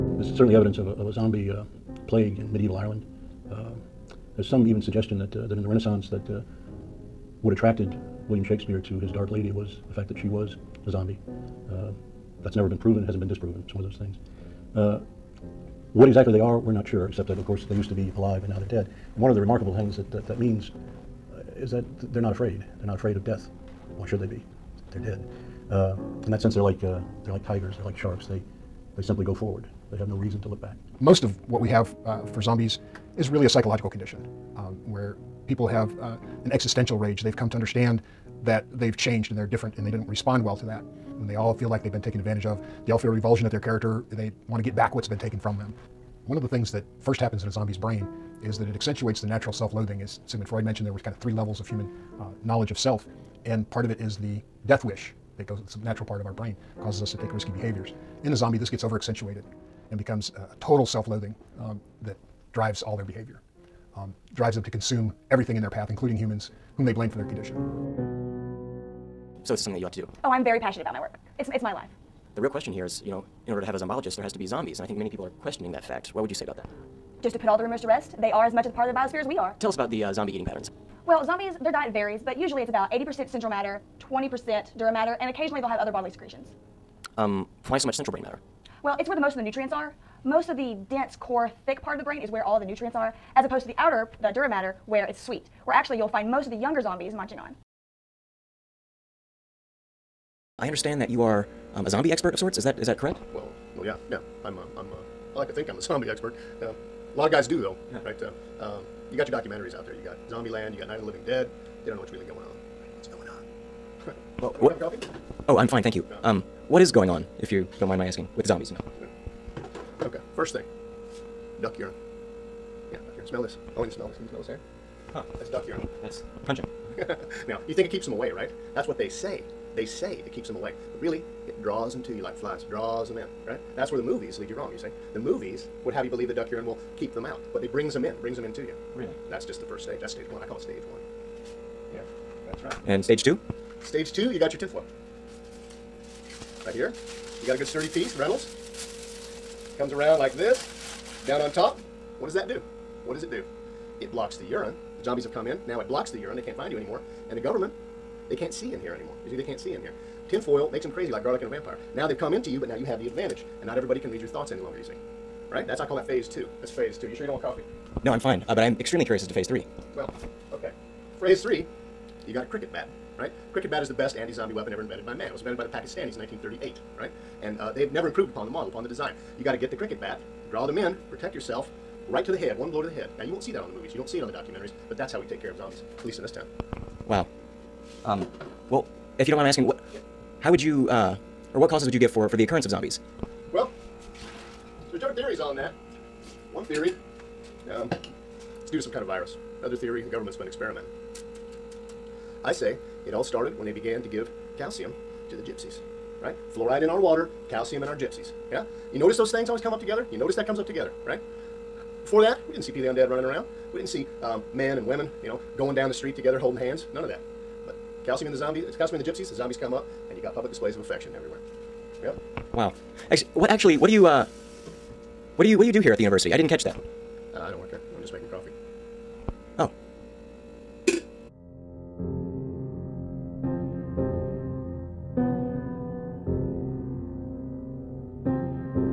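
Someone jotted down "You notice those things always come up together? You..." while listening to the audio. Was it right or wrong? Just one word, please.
right.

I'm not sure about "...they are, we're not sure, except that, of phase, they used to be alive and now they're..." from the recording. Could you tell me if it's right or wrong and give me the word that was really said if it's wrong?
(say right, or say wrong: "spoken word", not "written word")
wrong: "course", not "phase".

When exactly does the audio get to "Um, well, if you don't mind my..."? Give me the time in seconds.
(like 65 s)
188 s.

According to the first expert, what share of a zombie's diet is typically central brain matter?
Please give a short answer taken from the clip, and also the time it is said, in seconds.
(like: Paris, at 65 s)
80%, at 82 s.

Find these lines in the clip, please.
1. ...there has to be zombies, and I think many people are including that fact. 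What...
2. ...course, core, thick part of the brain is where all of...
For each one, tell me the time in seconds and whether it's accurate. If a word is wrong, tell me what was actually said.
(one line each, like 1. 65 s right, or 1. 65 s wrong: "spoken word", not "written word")
1. 74 s wrong: "questioning", not "including"
2. 90 s wrong: "dense", not "course".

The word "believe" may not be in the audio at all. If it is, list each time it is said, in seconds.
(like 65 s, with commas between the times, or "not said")
136 s.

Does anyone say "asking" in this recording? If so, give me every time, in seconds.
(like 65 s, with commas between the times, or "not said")
118 s, 189 s.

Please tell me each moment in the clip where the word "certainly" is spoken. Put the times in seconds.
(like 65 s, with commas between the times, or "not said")
0 s.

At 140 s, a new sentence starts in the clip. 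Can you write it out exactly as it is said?
I call it stage one that's right.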